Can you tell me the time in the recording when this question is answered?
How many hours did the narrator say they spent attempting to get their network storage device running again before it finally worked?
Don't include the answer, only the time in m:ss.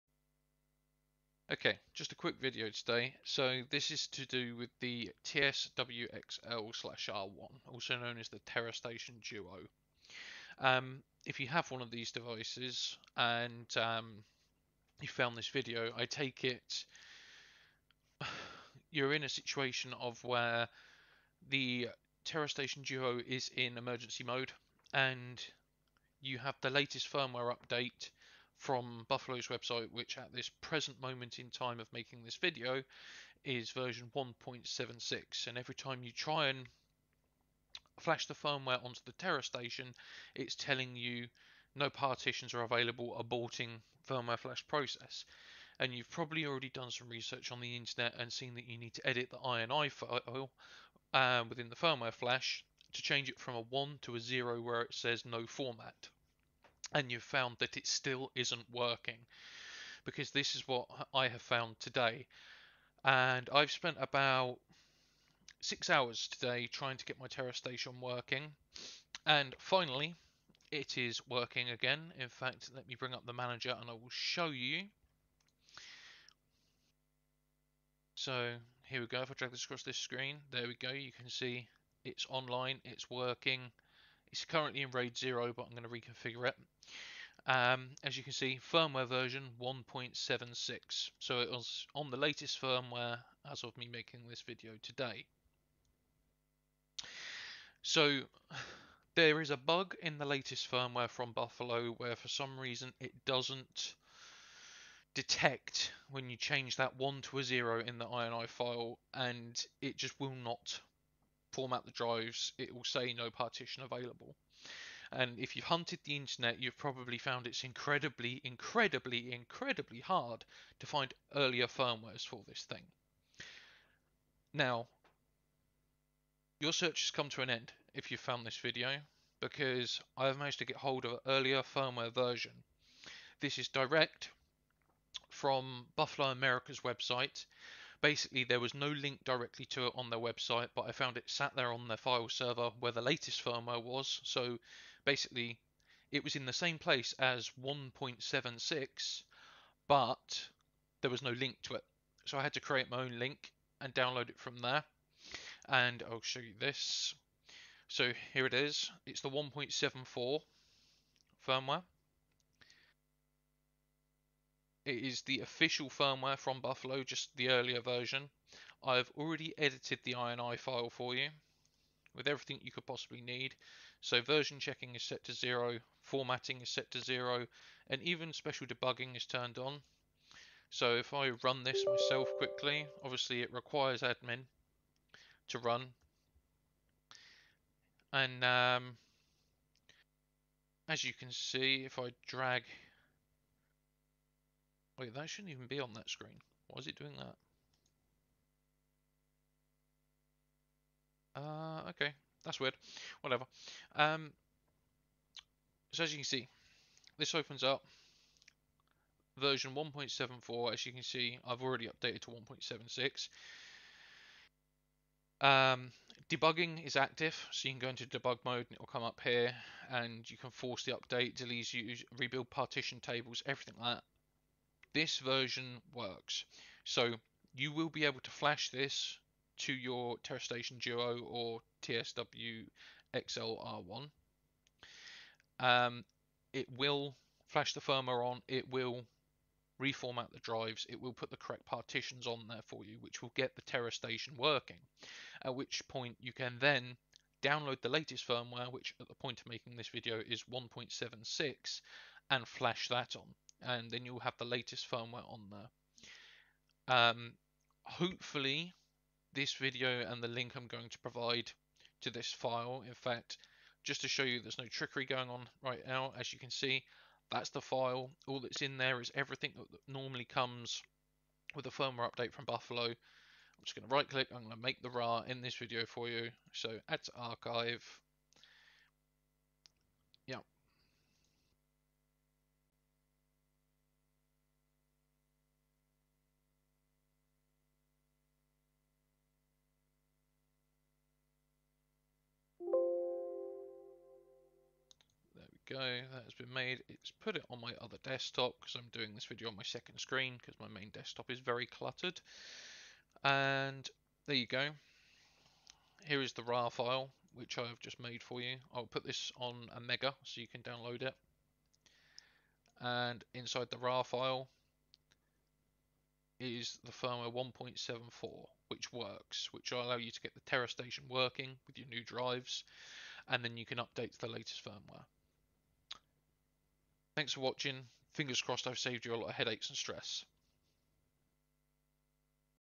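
1:05.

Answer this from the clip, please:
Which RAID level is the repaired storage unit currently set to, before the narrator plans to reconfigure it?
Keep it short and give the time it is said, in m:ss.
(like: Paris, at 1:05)
RAID 0, at 1:24.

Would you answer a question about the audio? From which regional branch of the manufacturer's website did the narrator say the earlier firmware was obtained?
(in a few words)
Buffalo America.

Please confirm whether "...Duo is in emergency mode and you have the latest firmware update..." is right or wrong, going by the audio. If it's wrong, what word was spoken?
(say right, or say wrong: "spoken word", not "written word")
right.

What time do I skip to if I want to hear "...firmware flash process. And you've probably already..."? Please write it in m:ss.
0:44.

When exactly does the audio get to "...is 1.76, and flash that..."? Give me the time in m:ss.
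4:10.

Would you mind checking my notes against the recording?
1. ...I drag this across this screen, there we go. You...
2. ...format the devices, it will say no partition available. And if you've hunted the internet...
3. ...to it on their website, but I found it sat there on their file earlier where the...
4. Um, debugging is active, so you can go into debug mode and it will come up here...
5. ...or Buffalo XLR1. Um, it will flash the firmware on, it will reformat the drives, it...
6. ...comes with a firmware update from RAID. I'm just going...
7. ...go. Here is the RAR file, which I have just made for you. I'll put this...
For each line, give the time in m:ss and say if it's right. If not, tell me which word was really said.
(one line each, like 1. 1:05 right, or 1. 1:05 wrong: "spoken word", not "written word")
1. 1:19 right
2. 1:51 wrong: "drives", not "devices"
3. 2:19 wrong: "server", not "earlier"
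4. 3:35 right
5. 3:51 wrong: "TSW", not "Buffalo"
6. 4:30 wrong: "Buffalo", not "RAID"
7. 5:04 right.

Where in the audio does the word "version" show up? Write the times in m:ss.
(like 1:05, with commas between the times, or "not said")
0:33, 1:29, 2:12, 2:47, 2:54, 3:29, 3:45.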